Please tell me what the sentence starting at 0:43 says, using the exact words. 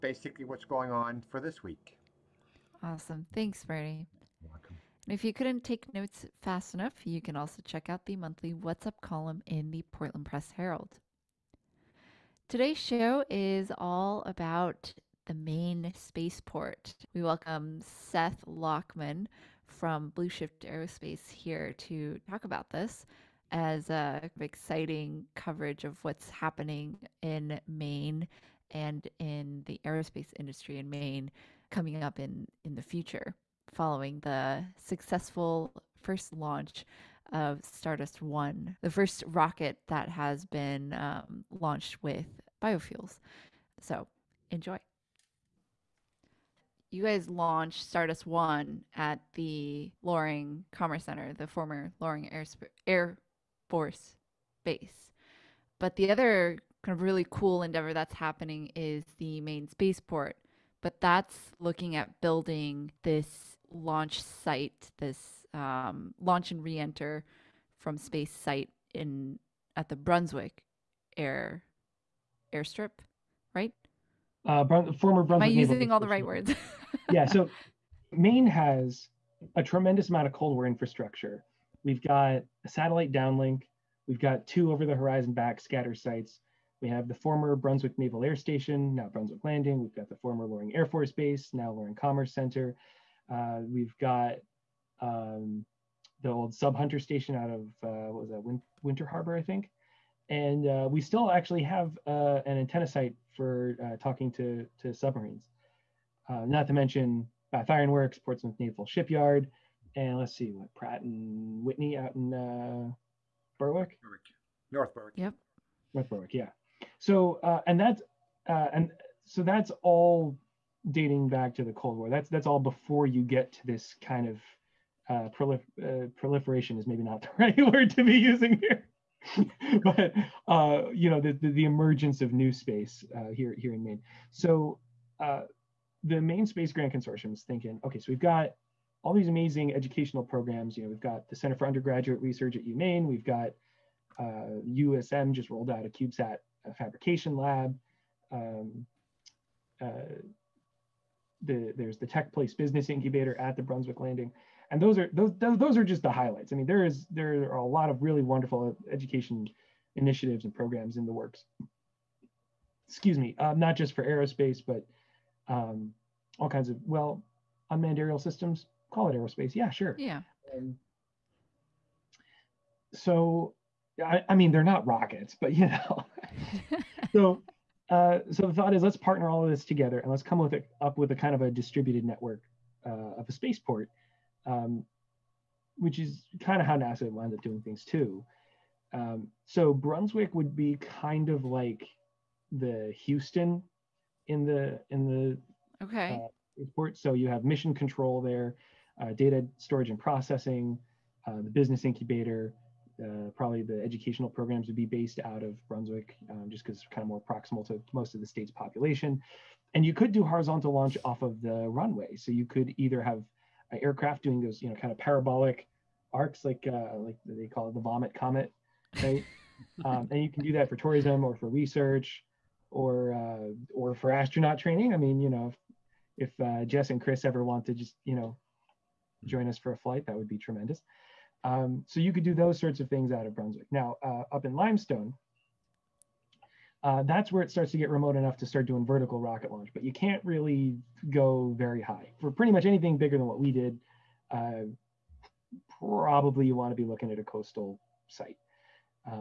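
So enjoy you guys launched Stardust One at the Loring Commerce Center, the former Loring Air, Air Force Base.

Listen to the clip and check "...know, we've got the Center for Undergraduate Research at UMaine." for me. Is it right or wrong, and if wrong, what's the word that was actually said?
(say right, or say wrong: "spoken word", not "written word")
right.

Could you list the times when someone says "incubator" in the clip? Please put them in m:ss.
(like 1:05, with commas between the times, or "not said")
2:32, 3:21.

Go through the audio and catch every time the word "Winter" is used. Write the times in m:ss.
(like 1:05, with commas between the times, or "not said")
1:38.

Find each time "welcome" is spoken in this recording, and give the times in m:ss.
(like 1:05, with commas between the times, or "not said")
0:04, 0:17.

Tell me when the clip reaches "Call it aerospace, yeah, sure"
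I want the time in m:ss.
2:48.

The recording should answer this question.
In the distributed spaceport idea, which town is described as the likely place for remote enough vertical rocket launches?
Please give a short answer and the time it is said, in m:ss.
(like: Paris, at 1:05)
Limestone, at 3:54.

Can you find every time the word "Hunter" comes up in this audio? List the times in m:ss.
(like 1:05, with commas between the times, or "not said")
1:36.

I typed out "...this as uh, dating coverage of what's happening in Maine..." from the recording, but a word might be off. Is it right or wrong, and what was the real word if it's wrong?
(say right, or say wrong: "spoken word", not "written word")
wrong: "exciting", not "dating".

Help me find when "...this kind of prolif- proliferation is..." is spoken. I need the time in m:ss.
2:03.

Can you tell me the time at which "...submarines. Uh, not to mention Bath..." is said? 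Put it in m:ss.
1:44.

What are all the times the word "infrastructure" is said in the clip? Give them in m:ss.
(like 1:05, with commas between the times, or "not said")
1:20.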